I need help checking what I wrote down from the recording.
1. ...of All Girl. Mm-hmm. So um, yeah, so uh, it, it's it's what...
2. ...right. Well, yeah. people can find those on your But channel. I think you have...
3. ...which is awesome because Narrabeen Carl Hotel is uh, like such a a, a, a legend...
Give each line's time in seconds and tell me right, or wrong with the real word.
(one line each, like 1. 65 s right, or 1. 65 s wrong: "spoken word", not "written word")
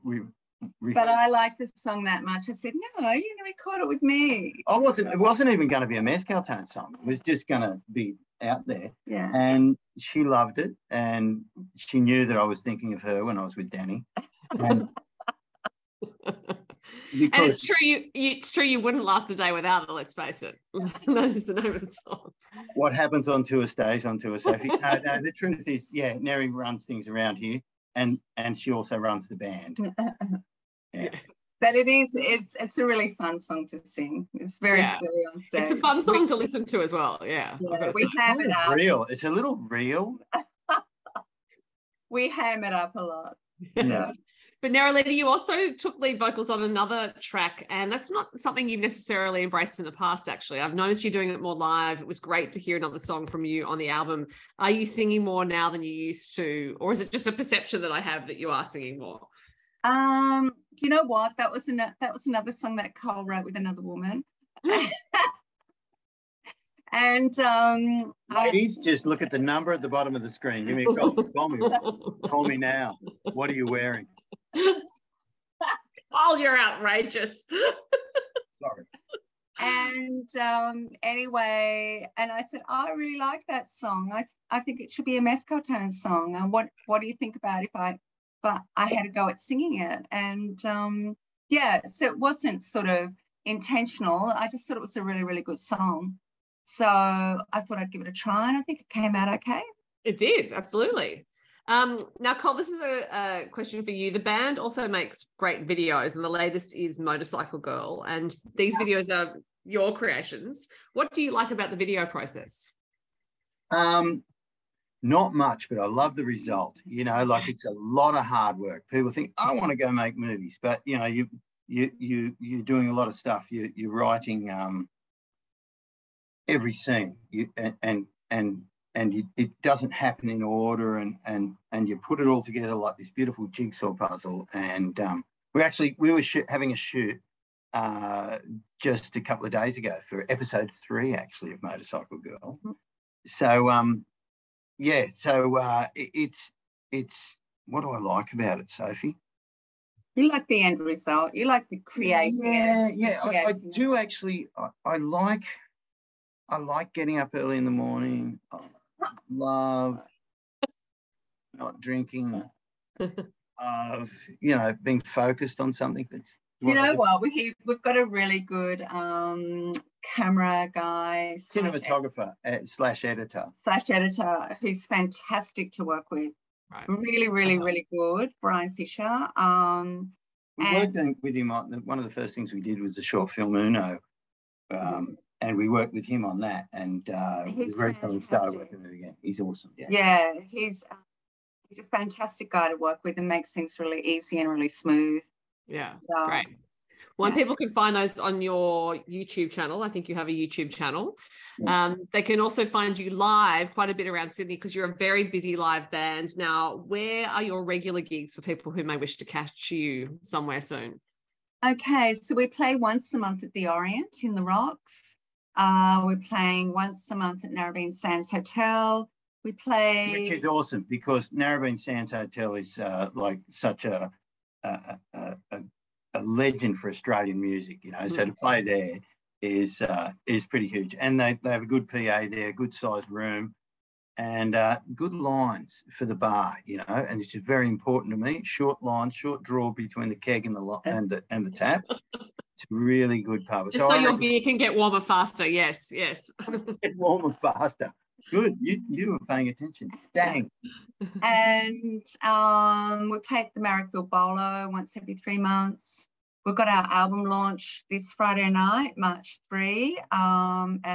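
1. 141 s wrong: "Motorcycle", not "All"
2. 196 s wrong: "YouTube", not "But"
3. 220 s wrong: "Sands", not "Carl".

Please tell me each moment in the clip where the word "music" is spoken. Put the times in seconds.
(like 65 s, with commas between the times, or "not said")
227 s.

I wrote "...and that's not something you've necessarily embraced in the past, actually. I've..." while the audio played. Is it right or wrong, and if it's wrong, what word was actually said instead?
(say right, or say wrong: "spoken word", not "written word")
right.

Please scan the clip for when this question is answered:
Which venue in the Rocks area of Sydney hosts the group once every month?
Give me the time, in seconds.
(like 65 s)
213 s.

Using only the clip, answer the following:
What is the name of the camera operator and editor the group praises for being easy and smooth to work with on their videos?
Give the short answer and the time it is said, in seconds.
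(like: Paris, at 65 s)
Brian Fisher, at 178 s.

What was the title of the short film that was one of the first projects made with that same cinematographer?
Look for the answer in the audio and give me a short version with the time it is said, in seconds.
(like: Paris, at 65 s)
Uno, at 183 s.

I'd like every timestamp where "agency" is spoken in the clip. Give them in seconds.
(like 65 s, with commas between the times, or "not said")
not said.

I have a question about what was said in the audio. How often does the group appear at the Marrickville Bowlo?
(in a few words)
Every 3 months.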